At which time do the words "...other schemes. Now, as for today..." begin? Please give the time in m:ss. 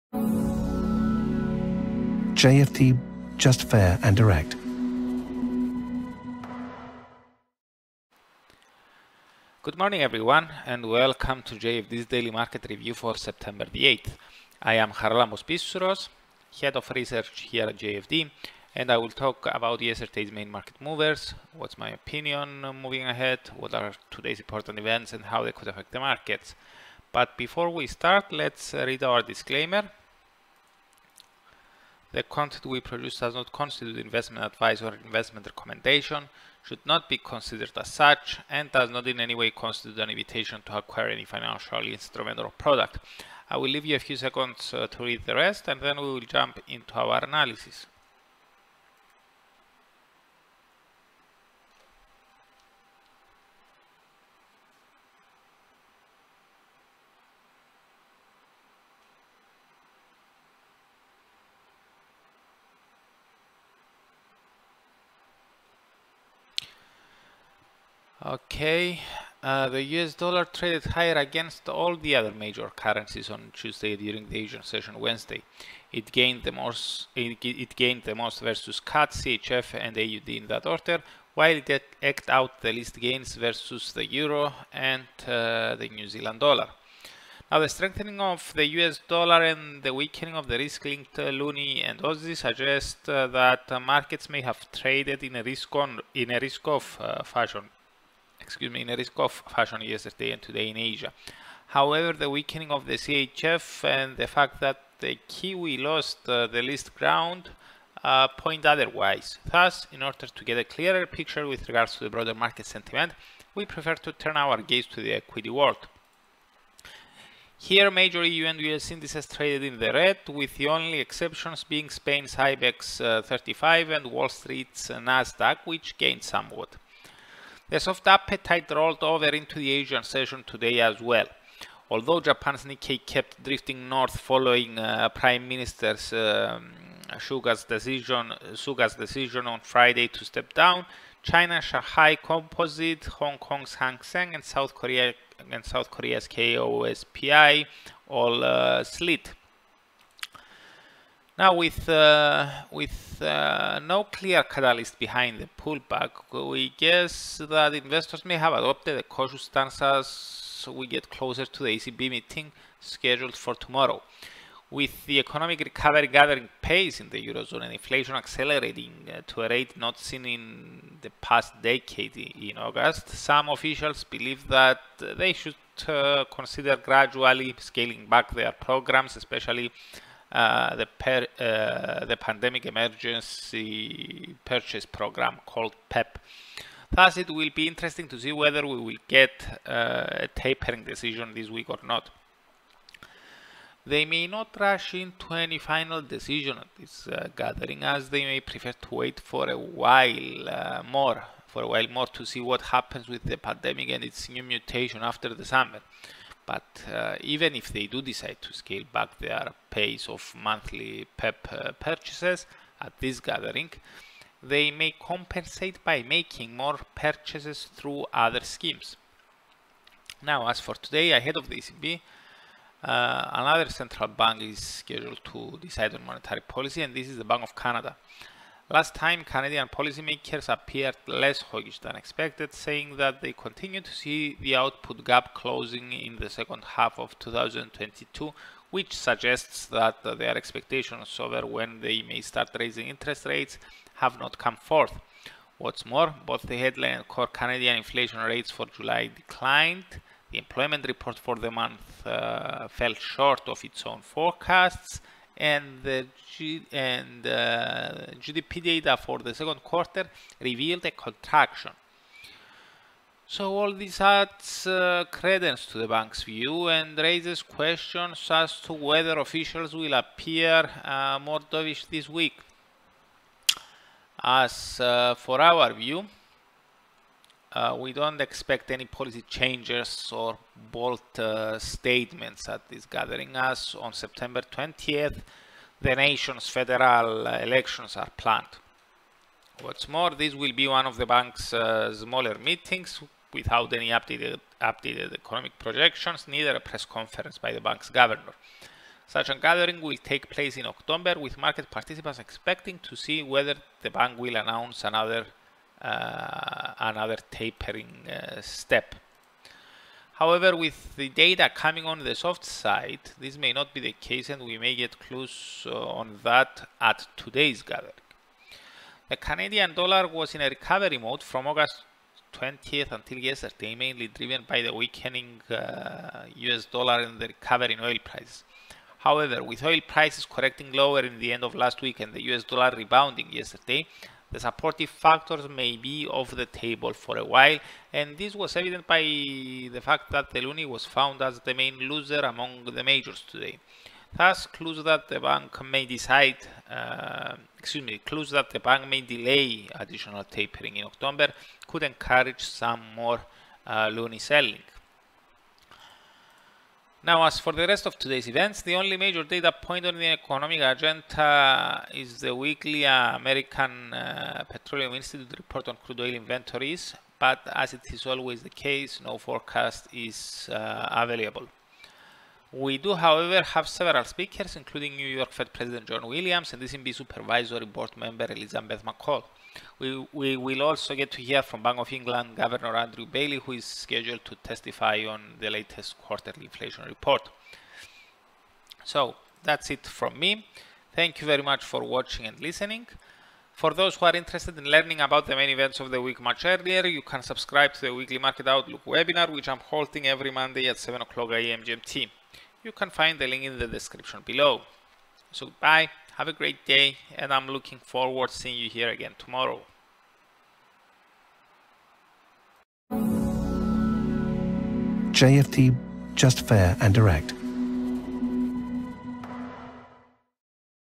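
3:38.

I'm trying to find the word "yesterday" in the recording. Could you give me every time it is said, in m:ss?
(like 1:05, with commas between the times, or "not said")
0:19, 1:39, 5:23, 5:33.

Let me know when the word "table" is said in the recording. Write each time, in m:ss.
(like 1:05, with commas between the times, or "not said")
5:36.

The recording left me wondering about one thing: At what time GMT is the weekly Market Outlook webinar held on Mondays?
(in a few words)
7 AM.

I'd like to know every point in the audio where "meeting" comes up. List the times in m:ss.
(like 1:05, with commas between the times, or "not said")
2:42, 4:52.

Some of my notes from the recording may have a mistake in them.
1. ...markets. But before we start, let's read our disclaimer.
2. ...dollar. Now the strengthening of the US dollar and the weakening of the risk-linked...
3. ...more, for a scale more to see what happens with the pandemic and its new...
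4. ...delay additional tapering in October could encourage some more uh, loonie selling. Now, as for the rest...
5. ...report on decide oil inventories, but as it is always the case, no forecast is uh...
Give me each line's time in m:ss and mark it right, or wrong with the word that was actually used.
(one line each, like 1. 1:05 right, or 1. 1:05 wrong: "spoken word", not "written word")
1. 0:26 right
2. 1:26 right
3. 3:20 wrong: "while", not "scale"
4. 5:49 right
5. 6:05 wrong: "crude", not "decide".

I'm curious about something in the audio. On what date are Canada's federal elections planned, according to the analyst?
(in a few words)
September 20th.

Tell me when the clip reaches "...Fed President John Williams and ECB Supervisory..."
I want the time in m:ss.
6:15.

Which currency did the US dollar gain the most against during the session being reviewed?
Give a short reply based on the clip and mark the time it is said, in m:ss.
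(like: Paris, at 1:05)
CAD, at 1:18.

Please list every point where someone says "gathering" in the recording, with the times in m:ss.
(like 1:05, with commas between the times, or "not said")
2:46, 3:17, 3:33, 4:42, 4:59, 5:17.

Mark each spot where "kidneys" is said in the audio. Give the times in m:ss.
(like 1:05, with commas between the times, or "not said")
not said.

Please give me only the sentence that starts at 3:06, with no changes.
Thus, it will be interesting to see whether we will get uh, a tapering decision this week or not.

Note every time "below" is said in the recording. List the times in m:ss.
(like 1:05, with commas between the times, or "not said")
6:44.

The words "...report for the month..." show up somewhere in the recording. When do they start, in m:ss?
4:10.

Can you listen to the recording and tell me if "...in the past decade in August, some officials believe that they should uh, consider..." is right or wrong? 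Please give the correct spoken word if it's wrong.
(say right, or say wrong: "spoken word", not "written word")
right.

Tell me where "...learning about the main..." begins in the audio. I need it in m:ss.
6:34.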